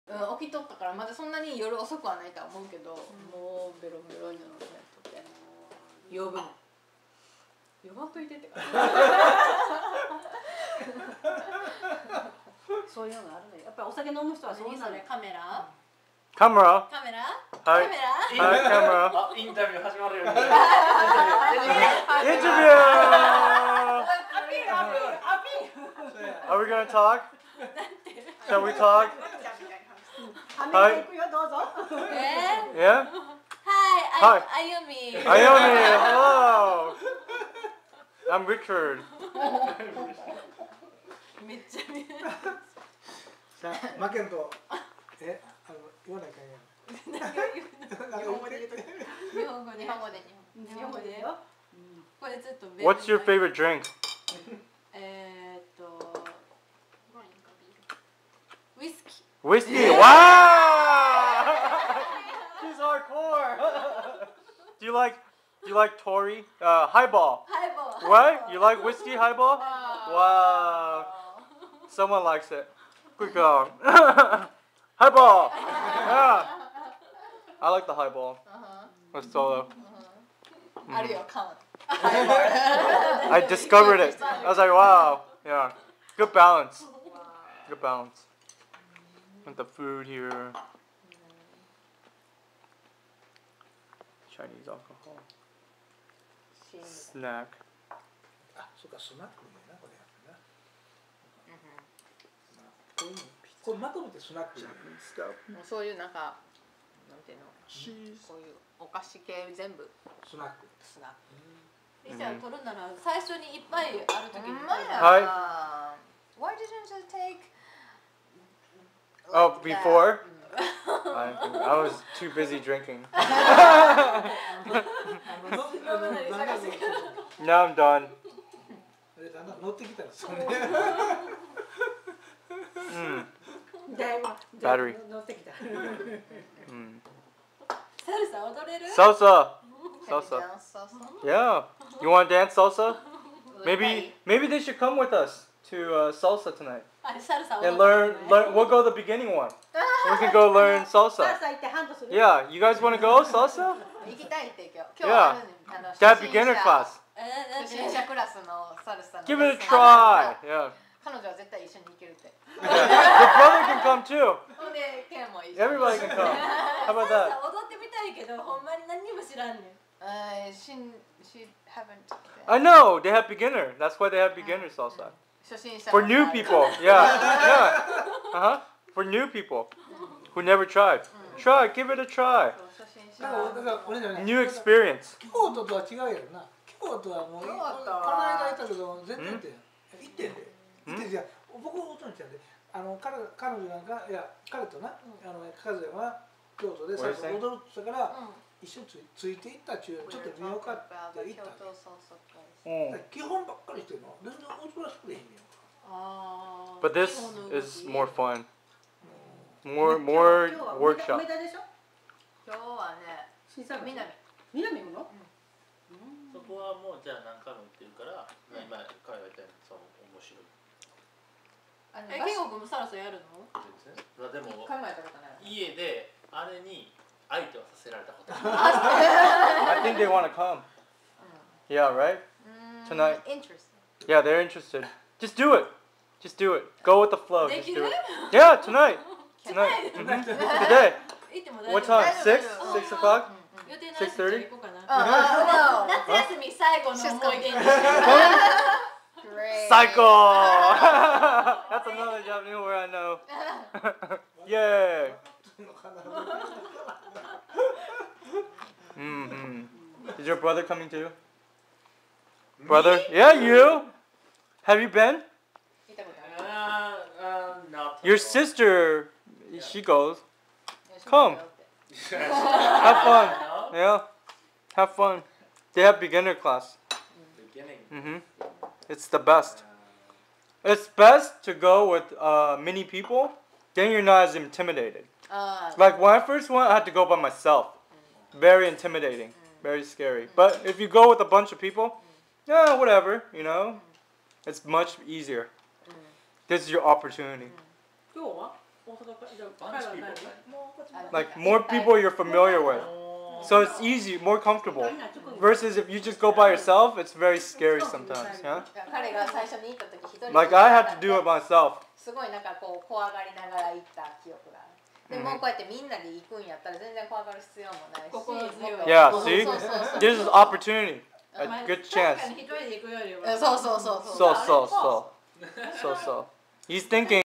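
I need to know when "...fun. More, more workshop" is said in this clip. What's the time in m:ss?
3:28.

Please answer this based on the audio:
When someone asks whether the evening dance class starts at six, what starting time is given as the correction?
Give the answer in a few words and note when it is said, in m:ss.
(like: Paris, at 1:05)
6:30, at 4:03.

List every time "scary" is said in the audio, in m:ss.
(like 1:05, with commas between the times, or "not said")
4:49, 5:07.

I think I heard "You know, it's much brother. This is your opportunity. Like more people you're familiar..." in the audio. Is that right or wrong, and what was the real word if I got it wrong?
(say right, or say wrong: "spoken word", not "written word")
wrong: "easier", not "brother".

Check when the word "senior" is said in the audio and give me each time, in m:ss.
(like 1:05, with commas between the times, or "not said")
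not said.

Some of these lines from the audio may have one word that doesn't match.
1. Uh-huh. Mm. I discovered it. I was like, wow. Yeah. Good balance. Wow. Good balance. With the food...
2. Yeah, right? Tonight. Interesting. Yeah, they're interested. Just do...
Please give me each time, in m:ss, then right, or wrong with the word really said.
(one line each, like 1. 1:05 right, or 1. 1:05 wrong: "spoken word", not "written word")
1. 1:19 right
2. 3:51 right.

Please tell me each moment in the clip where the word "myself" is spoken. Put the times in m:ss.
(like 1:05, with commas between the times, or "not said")
4:47, 5:11.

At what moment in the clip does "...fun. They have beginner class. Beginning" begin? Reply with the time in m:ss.
4:34.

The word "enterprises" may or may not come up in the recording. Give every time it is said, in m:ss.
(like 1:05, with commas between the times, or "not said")
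not said.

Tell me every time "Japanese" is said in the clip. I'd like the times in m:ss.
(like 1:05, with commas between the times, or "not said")
4:12.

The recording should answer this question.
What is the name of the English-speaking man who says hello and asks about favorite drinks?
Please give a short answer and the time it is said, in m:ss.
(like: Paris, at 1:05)
Richard, at 0:38.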